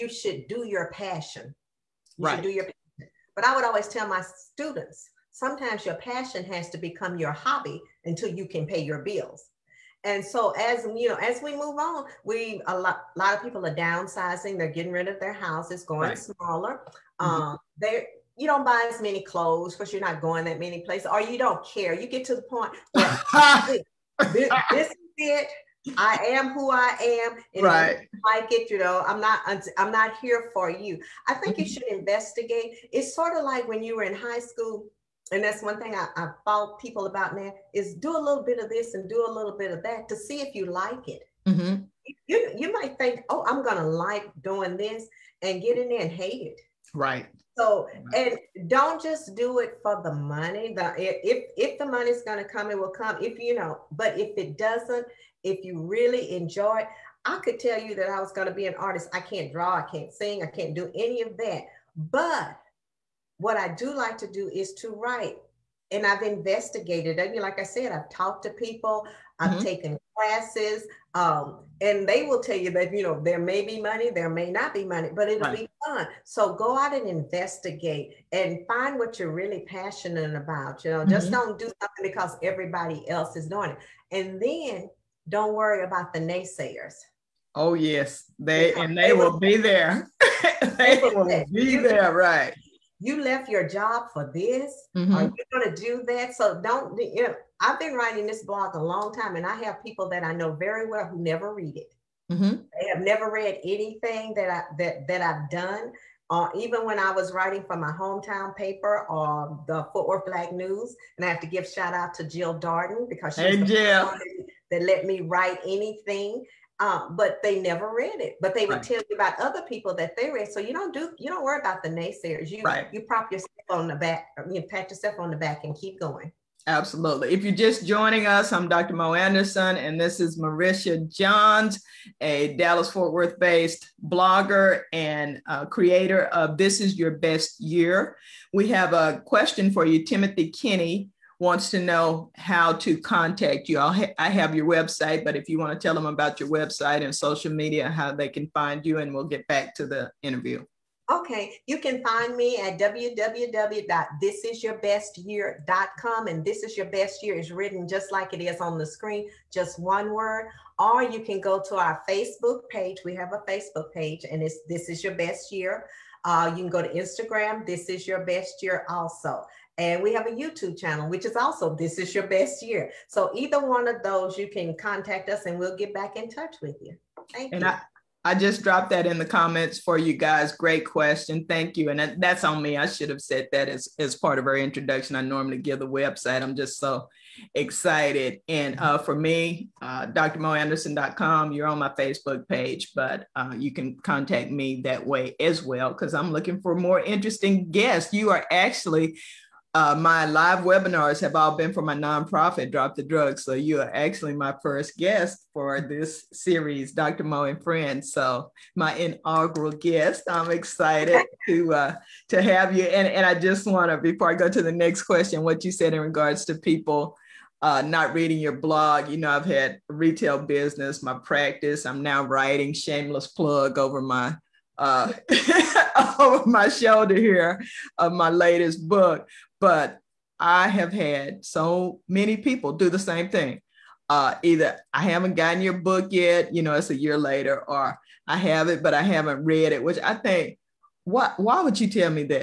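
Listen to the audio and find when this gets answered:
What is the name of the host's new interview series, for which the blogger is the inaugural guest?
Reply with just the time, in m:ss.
3:26.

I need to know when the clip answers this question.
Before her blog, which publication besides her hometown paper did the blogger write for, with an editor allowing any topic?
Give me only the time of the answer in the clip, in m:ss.
1:49.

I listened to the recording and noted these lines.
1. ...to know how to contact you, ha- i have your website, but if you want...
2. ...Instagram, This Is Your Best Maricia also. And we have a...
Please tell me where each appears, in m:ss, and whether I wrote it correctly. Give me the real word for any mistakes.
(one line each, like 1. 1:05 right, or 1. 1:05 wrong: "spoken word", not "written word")
1. 2:21 right
2. 2:46 wrong: "Year", not "Maricia".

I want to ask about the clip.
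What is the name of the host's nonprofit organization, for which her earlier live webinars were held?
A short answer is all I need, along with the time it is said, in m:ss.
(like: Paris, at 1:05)
Drop the Drugs, at 3:22.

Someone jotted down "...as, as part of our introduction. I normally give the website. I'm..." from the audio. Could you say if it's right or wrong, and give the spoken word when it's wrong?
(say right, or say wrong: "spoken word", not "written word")
right.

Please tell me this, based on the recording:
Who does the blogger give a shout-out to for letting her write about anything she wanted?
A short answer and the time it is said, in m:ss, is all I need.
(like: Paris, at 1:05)
Jill Darden, at 1:52.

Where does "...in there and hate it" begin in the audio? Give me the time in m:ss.
0:45.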